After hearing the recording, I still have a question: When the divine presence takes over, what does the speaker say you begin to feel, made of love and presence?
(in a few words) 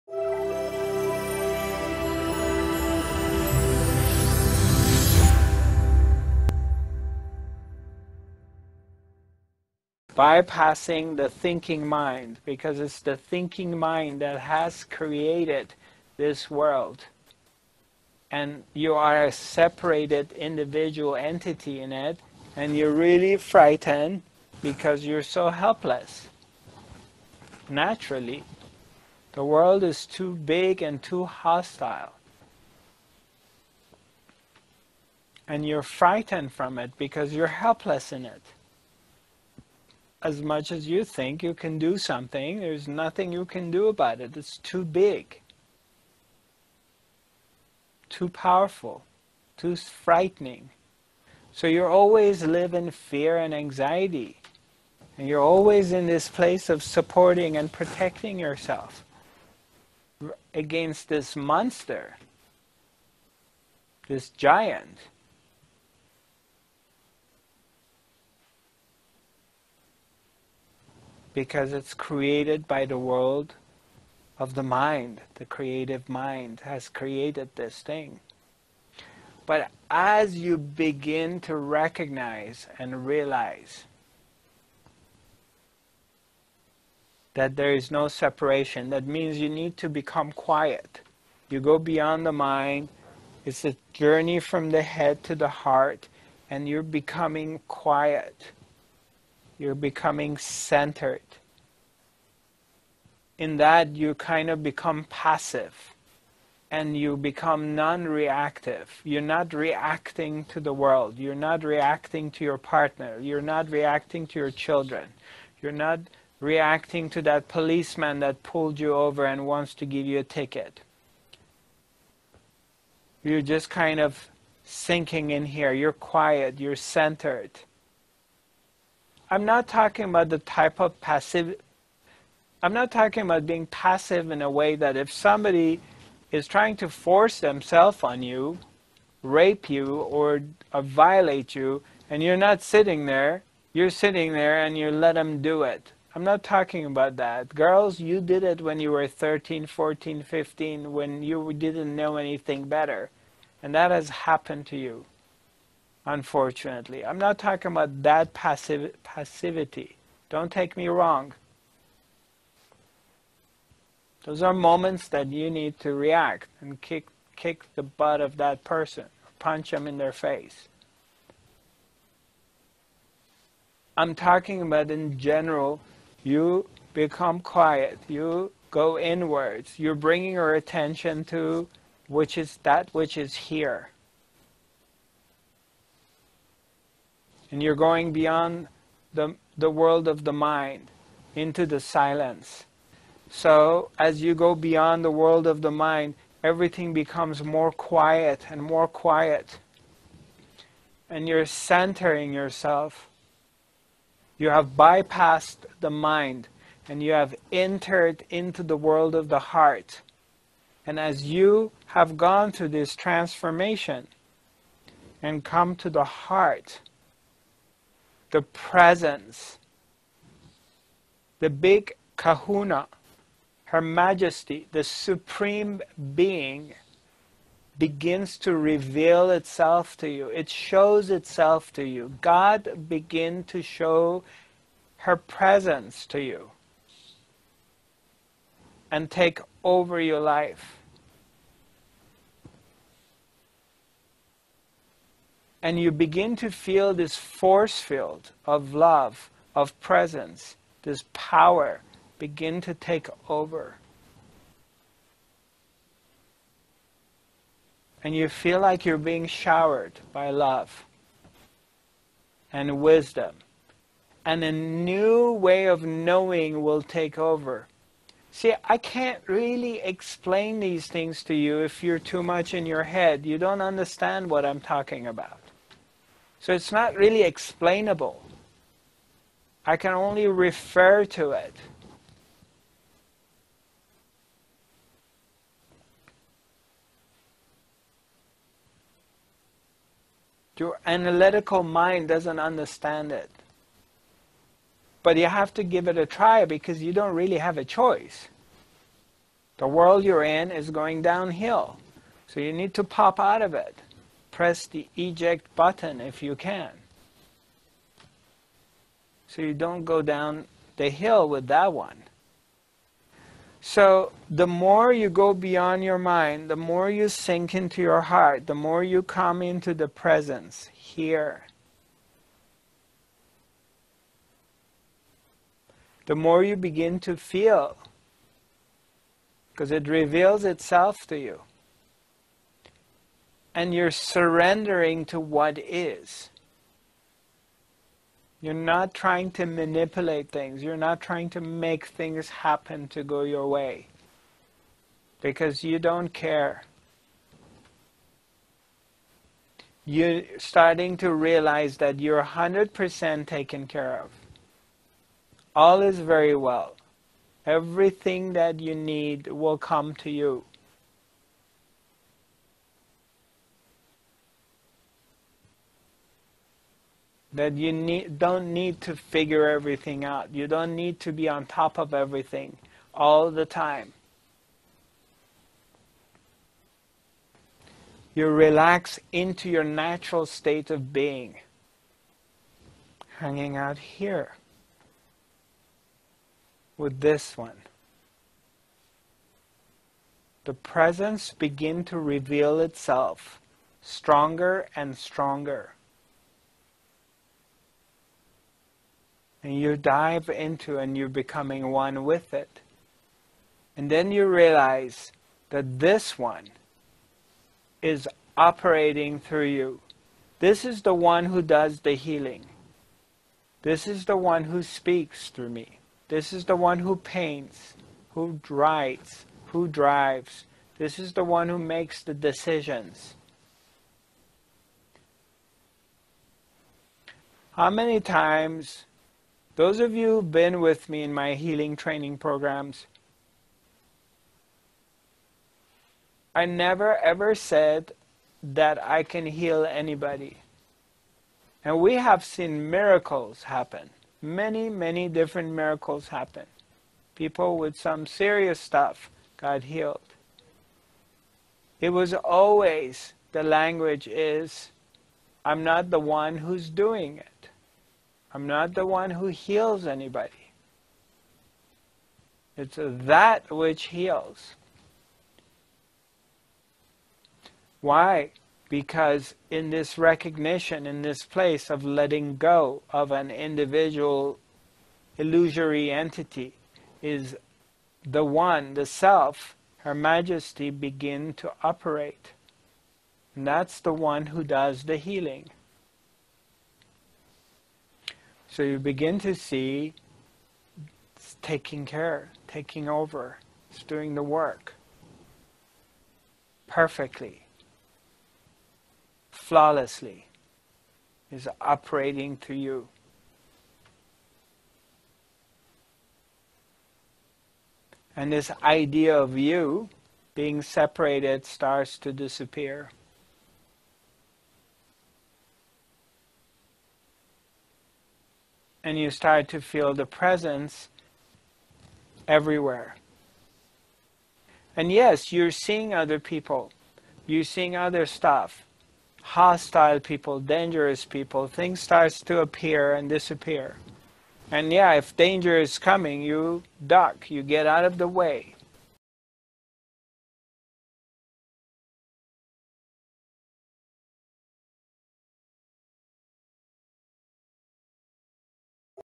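force field.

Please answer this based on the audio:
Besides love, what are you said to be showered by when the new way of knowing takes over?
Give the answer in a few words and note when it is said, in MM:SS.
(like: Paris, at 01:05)
wisdom, at 04:22.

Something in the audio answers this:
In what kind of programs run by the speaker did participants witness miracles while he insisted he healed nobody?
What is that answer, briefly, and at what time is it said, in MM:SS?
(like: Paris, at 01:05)
healing training programs, at 07:11.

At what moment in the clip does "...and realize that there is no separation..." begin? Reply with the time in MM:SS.
01:22.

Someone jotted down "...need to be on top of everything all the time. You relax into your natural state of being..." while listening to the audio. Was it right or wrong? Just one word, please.
right.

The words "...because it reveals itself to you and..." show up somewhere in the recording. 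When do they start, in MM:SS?
05:29.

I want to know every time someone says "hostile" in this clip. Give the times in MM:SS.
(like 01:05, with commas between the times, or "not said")
00:31, 08:49.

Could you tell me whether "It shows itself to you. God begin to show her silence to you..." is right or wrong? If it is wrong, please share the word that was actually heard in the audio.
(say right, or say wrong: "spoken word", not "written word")
wrong: "presence", not "silence".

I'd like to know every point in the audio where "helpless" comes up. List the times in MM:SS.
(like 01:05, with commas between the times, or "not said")
00:25, 00:37.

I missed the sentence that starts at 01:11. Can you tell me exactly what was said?
because it's created by the world of the mind.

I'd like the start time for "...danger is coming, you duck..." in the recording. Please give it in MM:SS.
08:55.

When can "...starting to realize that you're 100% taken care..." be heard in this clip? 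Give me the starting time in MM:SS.
05:50.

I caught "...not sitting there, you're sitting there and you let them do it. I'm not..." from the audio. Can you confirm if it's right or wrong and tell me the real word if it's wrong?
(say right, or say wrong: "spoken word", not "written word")
right.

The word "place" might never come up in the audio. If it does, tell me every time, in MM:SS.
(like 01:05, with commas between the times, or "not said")
00:56, 07:51.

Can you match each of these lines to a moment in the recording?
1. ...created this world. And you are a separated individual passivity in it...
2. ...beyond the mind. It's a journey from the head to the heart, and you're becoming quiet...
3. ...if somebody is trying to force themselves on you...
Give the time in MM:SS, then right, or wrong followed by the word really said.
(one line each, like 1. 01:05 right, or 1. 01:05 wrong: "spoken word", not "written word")
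1. 00:14 wrong: "entity", not "passivity"
2. 01:31 right
3. 02:14 right.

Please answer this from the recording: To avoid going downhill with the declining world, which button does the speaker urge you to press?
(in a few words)
eject button.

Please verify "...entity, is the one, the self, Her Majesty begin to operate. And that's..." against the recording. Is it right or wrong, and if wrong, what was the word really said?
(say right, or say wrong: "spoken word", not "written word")
right.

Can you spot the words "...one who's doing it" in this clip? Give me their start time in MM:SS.
07:35.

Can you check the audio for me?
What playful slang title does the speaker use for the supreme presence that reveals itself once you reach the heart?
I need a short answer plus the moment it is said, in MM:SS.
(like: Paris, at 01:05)
the big kahuna, at 03:41.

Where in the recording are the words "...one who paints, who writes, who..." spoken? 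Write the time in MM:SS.
06:56.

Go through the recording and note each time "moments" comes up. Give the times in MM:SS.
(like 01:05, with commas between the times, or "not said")
02:44.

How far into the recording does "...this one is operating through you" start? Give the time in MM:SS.
06:45.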